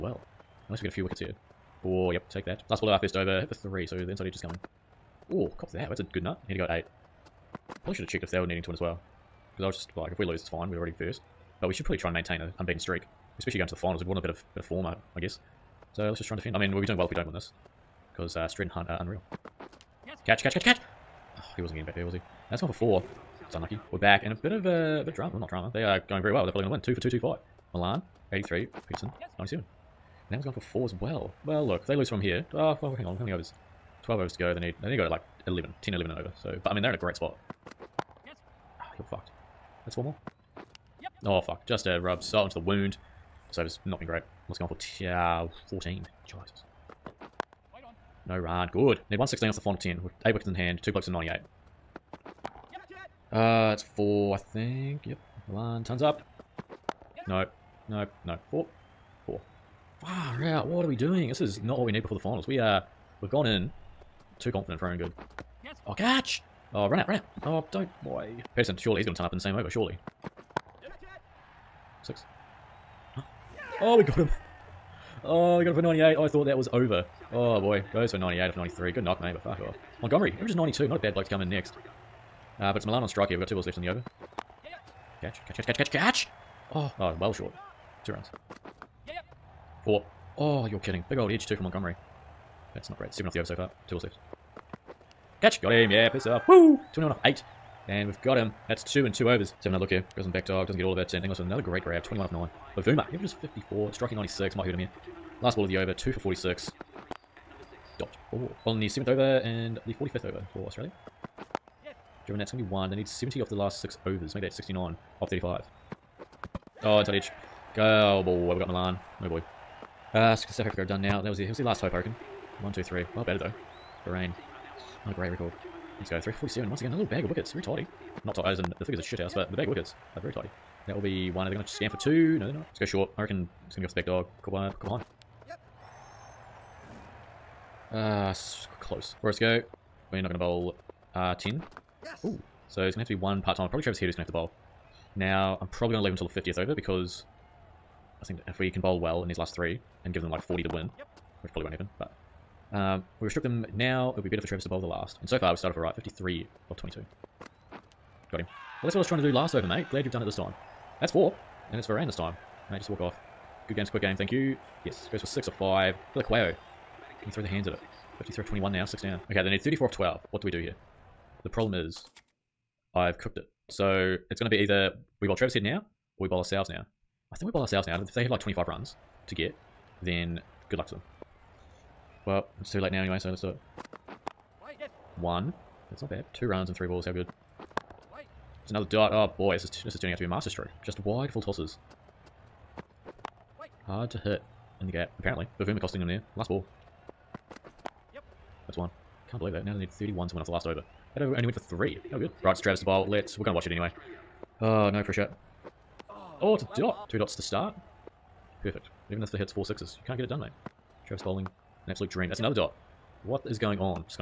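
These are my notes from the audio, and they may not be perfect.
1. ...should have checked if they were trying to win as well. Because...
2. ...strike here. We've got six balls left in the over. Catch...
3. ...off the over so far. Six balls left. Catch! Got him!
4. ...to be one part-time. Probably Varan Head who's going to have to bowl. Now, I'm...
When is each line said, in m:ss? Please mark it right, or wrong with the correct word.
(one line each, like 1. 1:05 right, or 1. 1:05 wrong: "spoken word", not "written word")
1. 0:07 wrong: "needing", not "trying"
2. 1:23 wrong: "two", not "six"
3. 1:33 wrong: "Two", not "Six"
4. 2:23 wrong: "Travis", not "Varan".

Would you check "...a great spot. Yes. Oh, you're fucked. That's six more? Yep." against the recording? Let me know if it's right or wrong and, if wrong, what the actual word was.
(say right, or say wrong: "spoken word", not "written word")
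wrong: "four", not "six".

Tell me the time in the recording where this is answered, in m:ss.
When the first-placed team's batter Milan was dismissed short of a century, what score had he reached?
1:15.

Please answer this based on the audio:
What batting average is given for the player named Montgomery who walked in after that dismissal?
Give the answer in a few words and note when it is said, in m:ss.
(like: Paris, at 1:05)
92, at 1:20.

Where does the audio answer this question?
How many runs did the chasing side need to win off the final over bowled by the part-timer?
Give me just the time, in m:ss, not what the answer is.
3:19.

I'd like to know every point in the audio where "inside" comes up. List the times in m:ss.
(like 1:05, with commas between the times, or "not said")
0:04, 1:56.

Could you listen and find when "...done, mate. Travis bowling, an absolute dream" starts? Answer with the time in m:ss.
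3:30.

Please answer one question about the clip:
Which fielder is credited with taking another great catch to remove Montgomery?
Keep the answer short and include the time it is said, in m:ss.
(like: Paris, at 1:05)
Inglis, at 1:41.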